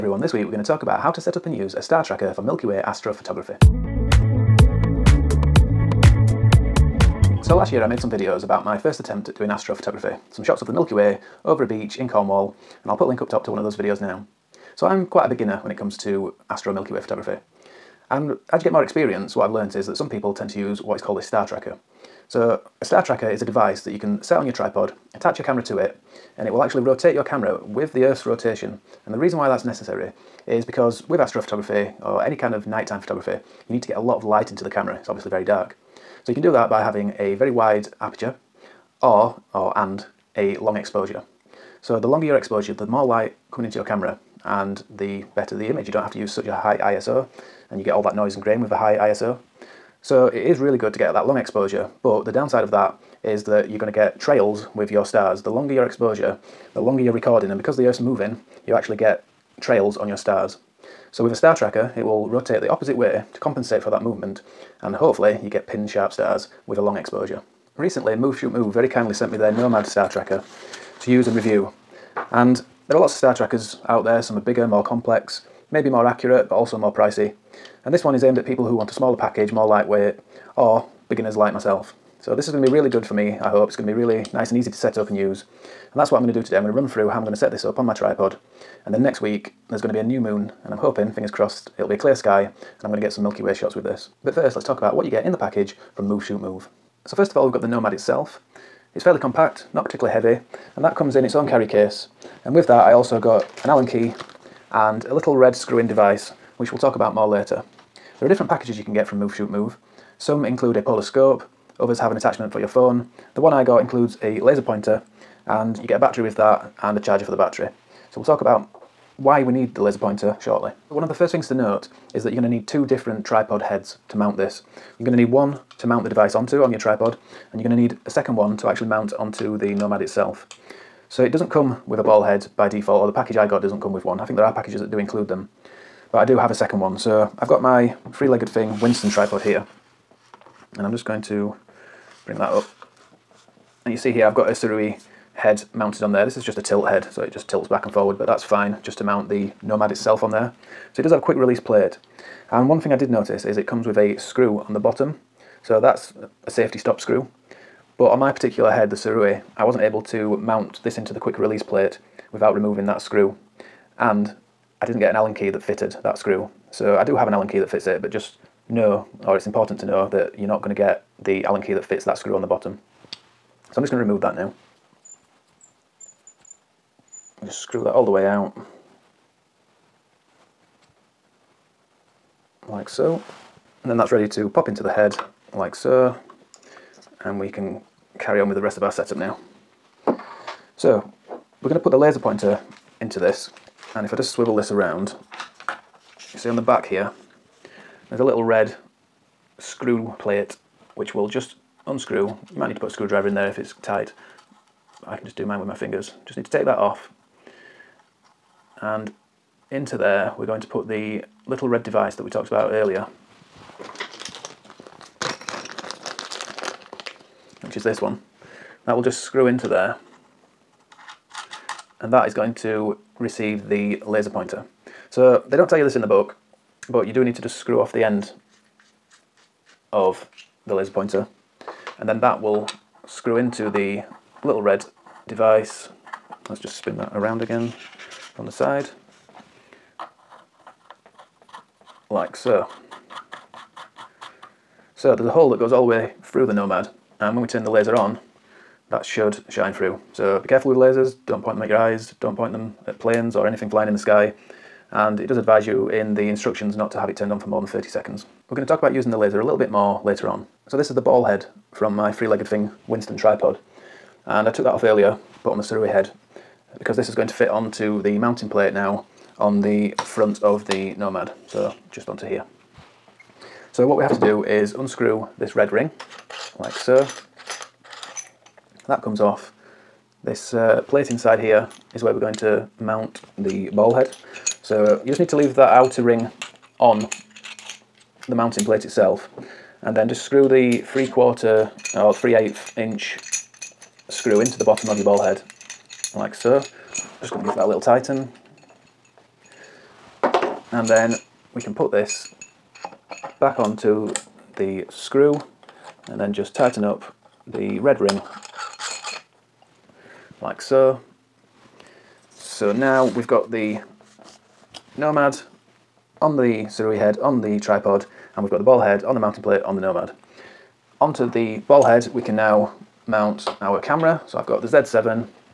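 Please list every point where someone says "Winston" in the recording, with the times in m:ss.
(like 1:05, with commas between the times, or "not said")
2:18, 4:22.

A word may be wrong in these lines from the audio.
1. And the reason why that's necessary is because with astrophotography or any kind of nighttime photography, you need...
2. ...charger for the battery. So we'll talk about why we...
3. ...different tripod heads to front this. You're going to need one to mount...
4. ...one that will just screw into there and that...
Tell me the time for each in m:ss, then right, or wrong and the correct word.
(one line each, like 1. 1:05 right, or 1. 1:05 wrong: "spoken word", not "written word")
1. 0:29 right
2. 1:56 right
3. 2:02 wrong: "mount", not "front"
4. 3:38 right.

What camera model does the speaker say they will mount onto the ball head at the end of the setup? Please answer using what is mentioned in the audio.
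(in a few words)
Z7.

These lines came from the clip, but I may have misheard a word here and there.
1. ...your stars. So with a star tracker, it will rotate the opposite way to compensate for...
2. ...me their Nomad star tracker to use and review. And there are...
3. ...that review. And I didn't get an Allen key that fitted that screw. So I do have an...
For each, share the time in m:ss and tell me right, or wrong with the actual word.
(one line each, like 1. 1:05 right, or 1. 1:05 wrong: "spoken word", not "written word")
1. 1:00 right
2. 1:09 right
3. 2:42 wrong: "screw", not "review".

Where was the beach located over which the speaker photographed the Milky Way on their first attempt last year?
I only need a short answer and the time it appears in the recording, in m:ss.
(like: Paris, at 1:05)
Cornwall, at 0:12.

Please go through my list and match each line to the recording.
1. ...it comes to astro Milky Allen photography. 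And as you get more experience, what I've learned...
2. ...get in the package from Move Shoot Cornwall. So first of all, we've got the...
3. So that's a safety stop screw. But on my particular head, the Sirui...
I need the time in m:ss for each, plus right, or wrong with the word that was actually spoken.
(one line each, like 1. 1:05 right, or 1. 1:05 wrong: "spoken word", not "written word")
1. 0:15 wrong: "Way", not "Allen"
2. 1:35 wrong: "Move", not "Cornwall"
3. 2:35 right.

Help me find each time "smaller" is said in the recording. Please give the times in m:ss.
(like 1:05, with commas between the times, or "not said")
1:18.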